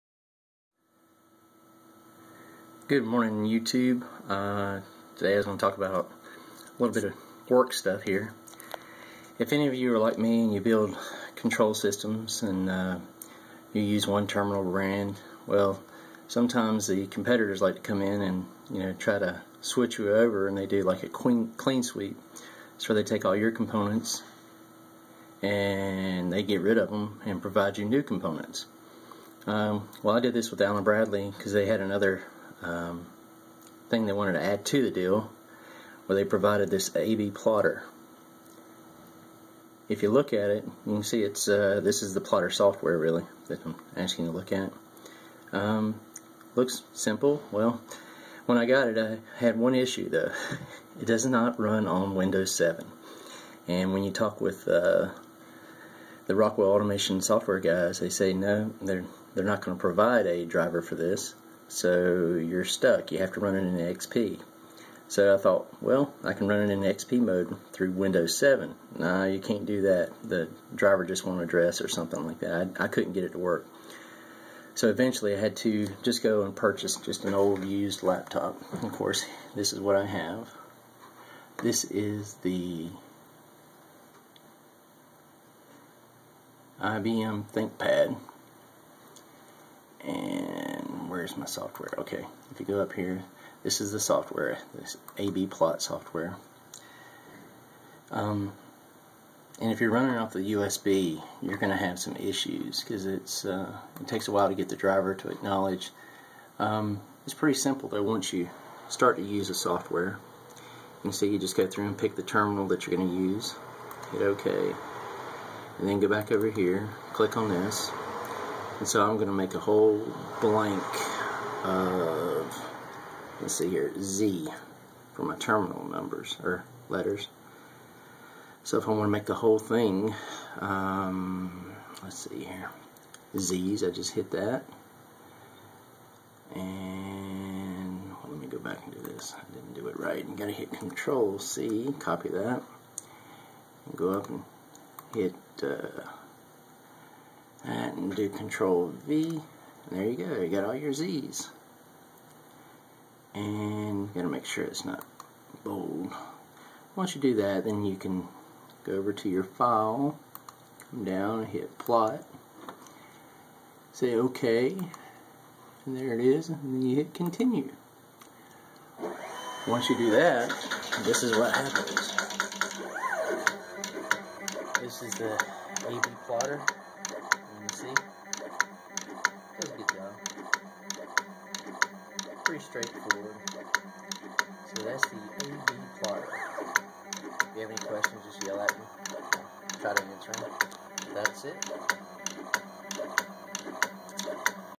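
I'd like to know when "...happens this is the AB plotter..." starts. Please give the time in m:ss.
2:51.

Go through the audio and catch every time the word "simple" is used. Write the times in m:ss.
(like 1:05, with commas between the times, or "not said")
0:46, 1:47.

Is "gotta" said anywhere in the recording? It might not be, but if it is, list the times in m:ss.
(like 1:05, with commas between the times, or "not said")
2:20, 2:34.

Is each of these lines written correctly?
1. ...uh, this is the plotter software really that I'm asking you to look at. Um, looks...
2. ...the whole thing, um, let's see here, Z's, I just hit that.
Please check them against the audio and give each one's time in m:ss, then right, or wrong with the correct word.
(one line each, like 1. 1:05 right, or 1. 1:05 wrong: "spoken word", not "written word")
1. 0:41 right
2. 2:09 right.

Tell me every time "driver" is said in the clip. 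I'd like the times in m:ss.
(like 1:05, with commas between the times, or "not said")
1:00, 1:10, 1:44.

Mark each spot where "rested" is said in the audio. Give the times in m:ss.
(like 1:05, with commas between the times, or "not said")
not said.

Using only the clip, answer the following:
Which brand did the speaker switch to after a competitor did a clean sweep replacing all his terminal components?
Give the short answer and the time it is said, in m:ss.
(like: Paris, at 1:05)
Allen Bradley, at 0:30.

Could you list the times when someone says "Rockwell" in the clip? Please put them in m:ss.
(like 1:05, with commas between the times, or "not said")
0:56.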